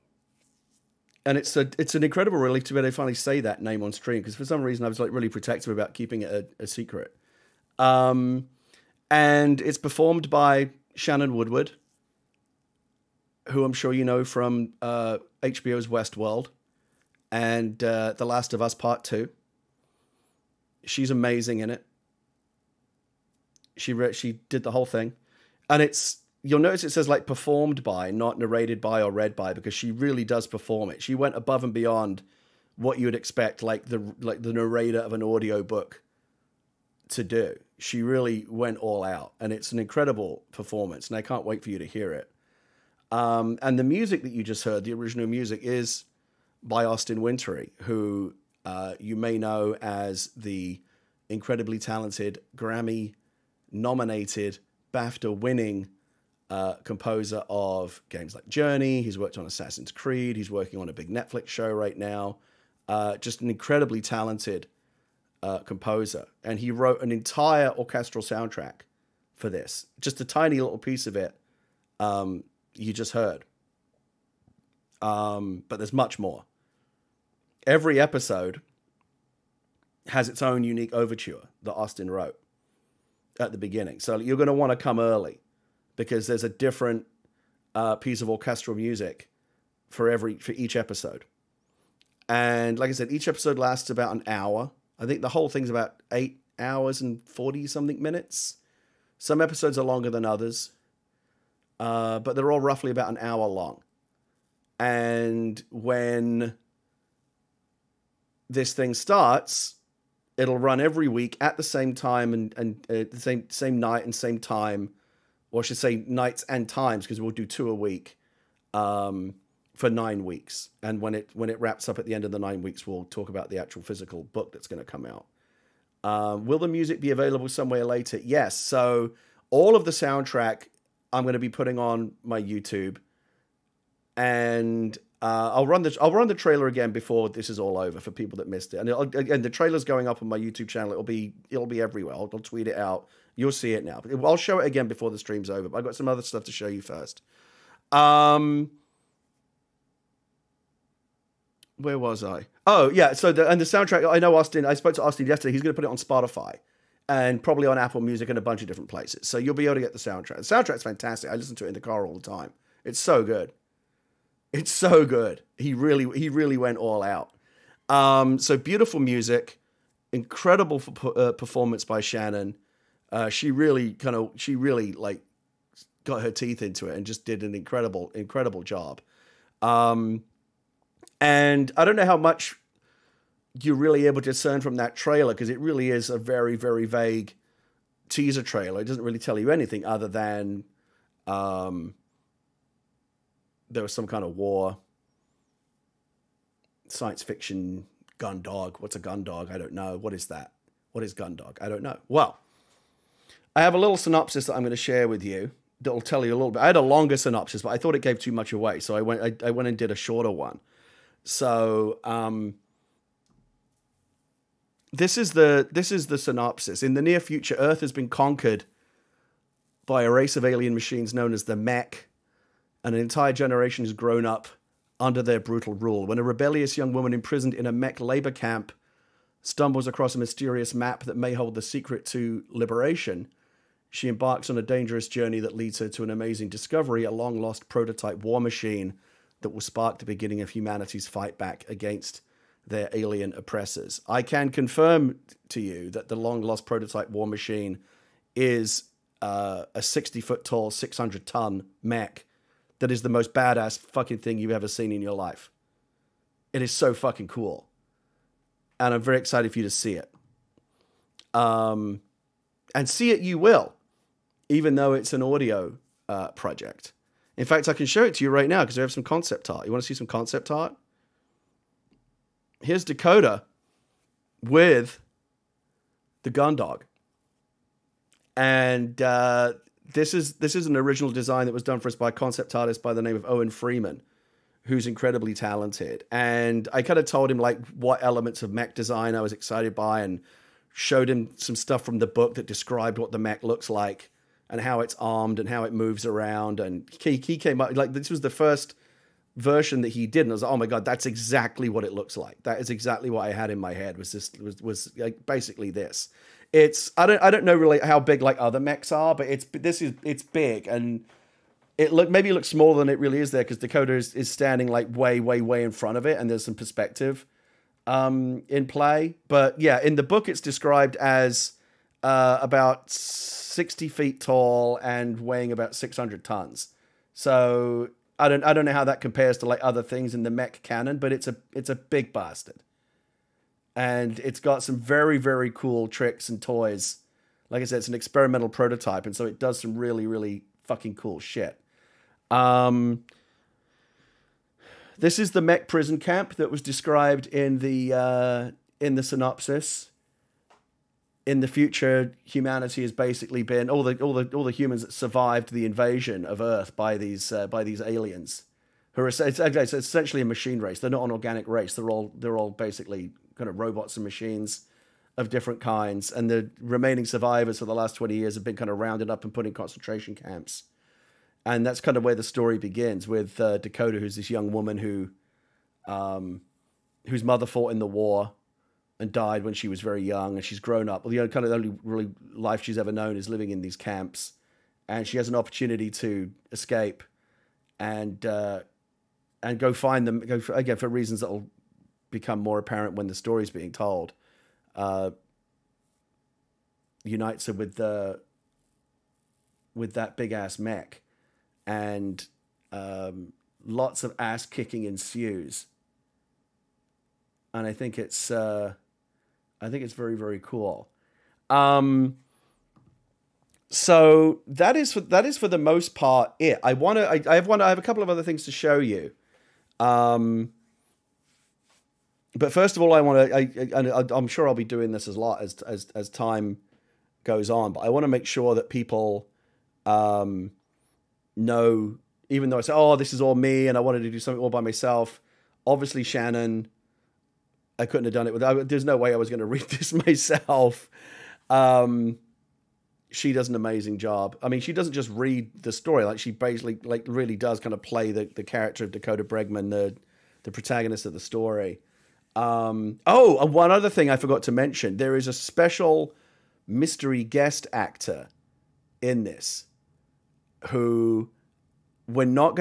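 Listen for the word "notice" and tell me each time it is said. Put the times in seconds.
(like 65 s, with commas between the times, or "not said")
26 s.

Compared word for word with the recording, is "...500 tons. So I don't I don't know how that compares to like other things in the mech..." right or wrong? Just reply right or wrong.
wrong.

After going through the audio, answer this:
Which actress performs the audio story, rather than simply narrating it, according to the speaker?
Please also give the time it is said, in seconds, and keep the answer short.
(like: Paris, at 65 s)
Shannon Woodward, at 10 s.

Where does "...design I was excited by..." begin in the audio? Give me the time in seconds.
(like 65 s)
288 s.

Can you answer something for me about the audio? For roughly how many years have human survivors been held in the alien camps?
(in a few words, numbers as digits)
20 years.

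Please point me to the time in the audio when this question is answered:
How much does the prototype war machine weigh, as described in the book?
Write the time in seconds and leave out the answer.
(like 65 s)
250 s.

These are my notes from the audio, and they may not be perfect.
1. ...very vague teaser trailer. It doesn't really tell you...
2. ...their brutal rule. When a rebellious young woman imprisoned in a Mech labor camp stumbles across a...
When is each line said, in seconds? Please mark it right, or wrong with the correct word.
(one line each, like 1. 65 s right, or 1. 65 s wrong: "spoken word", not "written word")
1. 186 s right
2. 225 s right.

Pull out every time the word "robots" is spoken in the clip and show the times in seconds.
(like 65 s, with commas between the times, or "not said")
363 s.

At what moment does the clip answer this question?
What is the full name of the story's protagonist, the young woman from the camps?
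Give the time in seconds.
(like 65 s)
448 s.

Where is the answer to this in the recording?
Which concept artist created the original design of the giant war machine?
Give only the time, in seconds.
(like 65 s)
283 s.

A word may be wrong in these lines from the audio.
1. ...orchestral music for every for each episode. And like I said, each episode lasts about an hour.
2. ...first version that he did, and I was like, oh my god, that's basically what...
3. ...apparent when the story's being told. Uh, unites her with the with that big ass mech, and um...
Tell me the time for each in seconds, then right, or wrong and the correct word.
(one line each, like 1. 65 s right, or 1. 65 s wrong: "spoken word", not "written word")
1. 88 s right
2. 298 s wrong: "exactly", not "basically"
3. 392 s right.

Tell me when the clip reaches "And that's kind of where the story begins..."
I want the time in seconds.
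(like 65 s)
371 s.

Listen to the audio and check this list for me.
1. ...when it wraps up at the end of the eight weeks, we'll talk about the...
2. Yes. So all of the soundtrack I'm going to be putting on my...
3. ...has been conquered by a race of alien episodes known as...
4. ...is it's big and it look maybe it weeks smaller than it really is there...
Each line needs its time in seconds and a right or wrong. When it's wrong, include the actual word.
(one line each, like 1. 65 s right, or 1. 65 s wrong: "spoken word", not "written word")
1. 121 s wrong: "nine", not "eight"
2. 128 s right
3. 217 s wrong: "machines", not "episodes"
4. 309 s wrong: "looks", not "weeks".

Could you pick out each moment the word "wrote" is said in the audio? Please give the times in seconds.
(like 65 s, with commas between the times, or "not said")
66 s, 82 s.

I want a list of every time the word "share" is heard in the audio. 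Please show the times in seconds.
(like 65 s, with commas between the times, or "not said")
204 s.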